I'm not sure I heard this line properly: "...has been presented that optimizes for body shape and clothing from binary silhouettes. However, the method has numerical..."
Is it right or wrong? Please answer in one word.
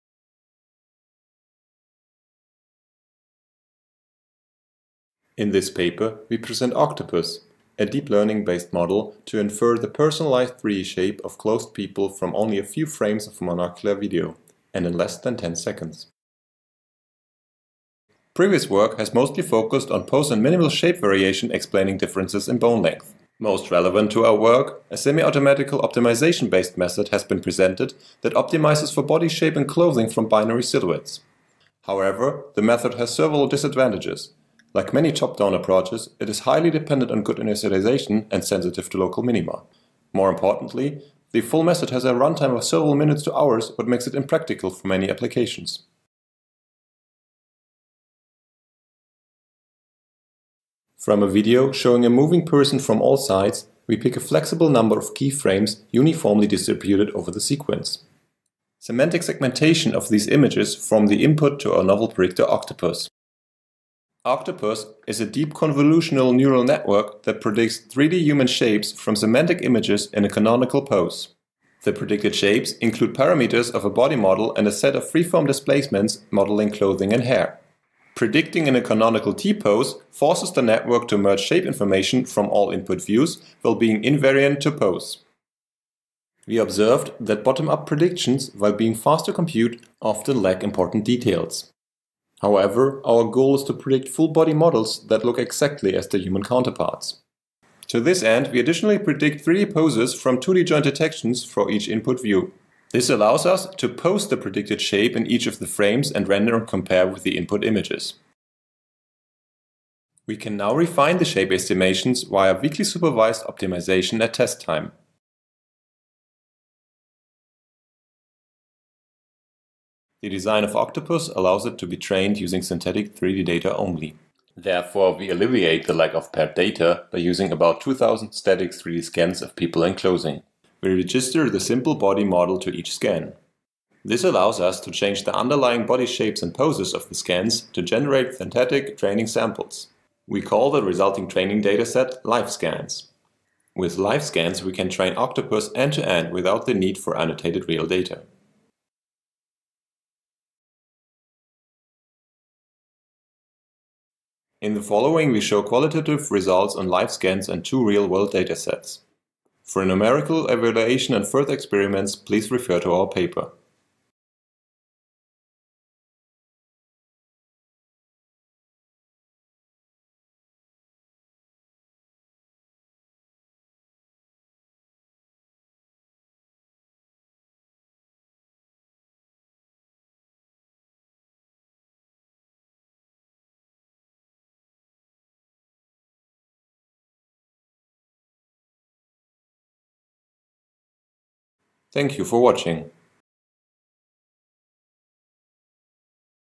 wrong.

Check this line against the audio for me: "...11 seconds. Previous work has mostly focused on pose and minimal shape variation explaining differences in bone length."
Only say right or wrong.
wrong.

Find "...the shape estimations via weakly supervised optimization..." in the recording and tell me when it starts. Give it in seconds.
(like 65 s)
111 s.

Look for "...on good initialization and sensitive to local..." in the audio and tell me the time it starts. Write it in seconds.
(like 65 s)
37 s.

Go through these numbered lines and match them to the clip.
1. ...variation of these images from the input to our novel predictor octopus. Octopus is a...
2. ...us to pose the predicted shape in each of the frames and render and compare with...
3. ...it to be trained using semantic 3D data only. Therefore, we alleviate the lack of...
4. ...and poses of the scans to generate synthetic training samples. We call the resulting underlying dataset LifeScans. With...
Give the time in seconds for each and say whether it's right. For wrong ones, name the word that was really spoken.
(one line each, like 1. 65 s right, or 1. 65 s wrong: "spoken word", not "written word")
1. 59 s wrong: "segmentation", not "variation"
2. 103 s right
3. 121 s wrong: "synthetic", not "semantic"
4. 136 s wrong: "training", not "underlying".